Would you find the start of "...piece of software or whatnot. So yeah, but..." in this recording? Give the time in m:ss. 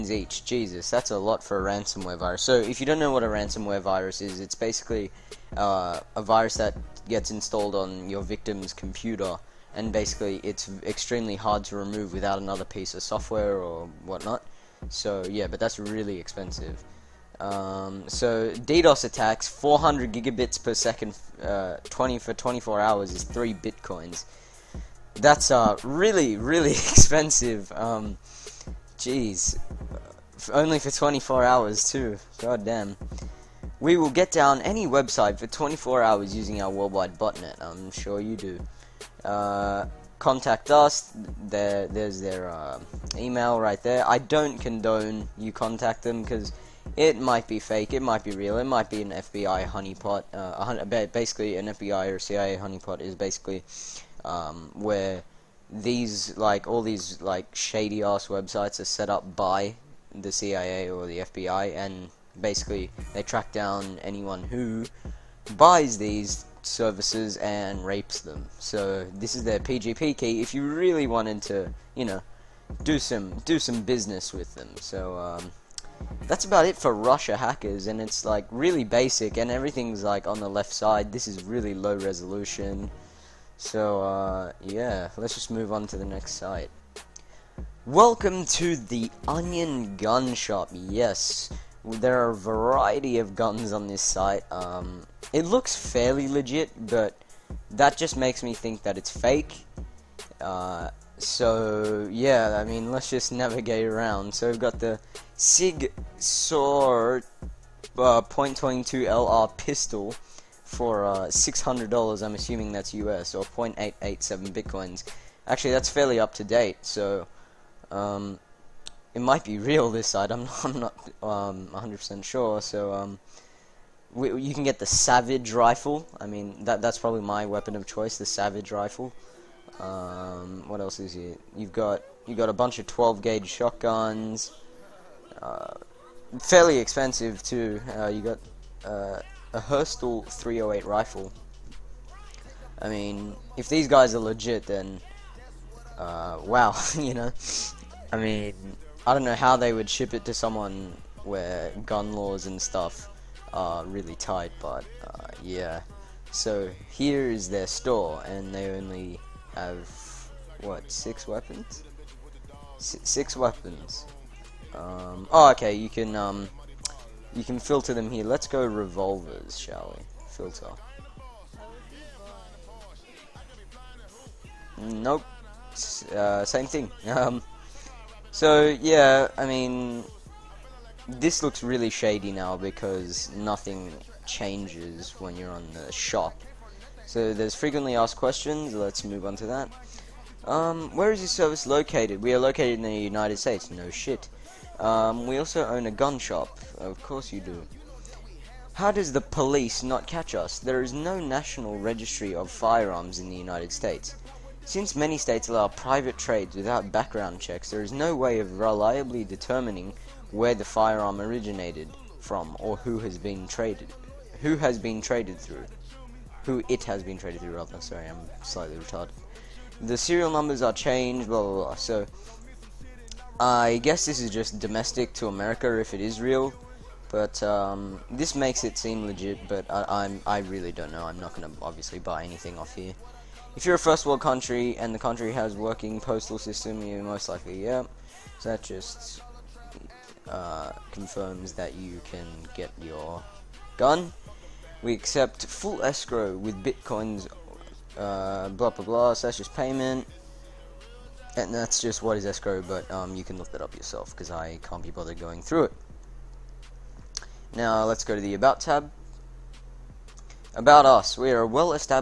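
0:12.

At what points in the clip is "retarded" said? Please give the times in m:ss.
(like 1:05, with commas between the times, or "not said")
3:38.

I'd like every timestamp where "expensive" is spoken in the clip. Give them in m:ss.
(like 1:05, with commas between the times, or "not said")
0:16, 0:26, 2:16.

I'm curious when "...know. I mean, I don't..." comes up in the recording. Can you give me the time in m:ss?
2:27.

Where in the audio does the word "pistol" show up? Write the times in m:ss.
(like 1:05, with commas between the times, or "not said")
1:49.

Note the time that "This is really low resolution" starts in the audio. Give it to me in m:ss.
1:21.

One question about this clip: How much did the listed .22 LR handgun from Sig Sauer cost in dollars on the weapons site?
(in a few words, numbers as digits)
$600.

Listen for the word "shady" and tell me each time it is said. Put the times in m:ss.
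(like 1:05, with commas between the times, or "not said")
0:57, 3:01.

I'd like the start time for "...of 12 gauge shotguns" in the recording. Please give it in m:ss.
2:12.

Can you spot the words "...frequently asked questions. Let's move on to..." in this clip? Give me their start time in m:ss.
3:07.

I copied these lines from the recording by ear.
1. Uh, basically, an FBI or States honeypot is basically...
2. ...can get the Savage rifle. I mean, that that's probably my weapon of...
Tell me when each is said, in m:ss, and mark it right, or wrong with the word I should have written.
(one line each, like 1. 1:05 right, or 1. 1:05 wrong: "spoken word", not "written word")
1. 0:50 wrong: "CIA", not "States"
2. 2:04 right.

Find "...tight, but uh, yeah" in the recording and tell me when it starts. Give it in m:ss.
2:34.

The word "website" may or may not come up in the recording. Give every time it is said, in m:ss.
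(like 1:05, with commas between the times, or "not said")
0:34, 0:58.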